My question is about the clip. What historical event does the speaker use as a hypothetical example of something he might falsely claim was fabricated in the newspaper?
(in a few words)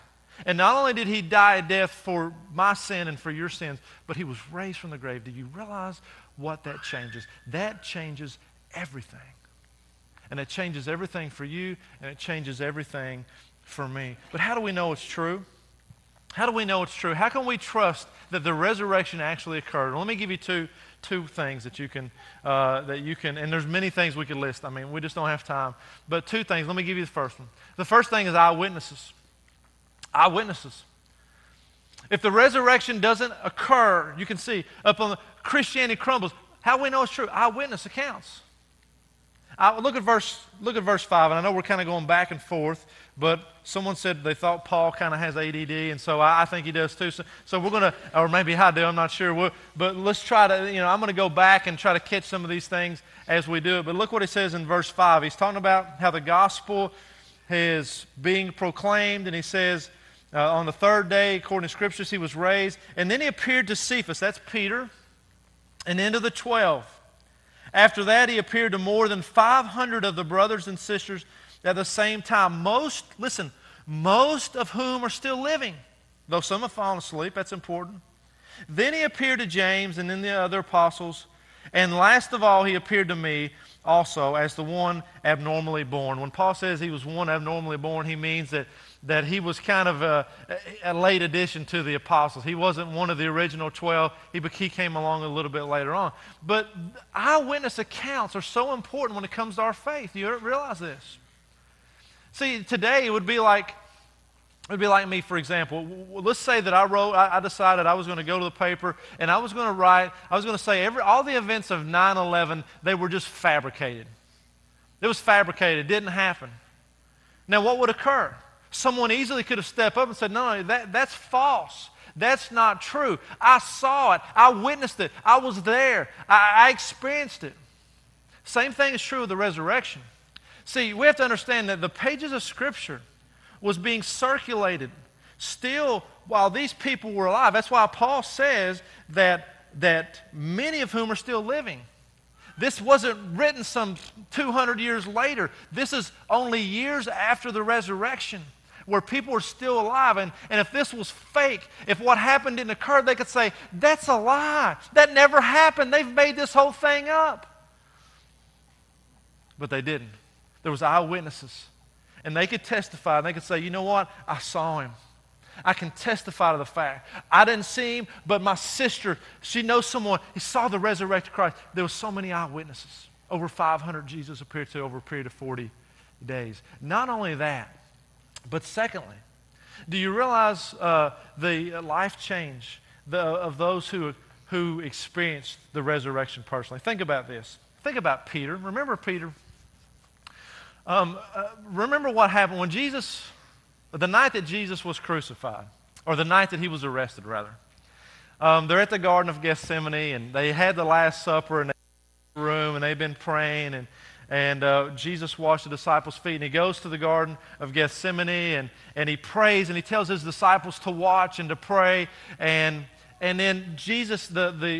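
9/11.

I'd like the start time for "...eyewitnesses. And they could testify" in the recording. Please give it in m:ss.
2:40.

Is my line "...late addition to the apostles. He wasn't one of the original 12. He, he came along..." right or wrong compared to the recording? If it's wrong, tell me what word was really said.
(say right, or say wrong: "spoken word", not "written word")
right.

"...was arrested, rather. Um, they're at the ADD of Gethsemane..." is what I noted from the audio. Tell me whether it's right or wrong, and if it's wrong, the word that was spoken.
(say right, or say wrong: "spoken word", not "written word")
wrong: "Garden", not "ADD".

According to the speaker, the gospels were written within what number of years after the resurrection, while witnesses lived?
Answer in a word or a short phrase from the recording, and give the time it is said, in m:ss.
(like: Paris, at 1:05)
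200, at 2:24.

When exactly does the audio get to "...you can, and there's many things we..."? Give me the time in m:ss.
0:22.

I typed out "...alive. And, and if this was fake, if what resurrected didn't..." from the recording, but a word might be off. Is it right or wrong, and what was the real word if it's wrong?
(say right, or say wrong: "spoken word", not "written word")
wrong: "happened", not "resurrected".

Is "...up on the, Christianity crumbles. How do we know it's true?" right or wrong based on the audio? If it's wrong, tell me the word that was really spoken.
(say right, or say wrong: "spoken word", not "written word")
right.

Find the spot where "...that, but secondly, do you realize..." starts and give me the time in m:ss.
2:57.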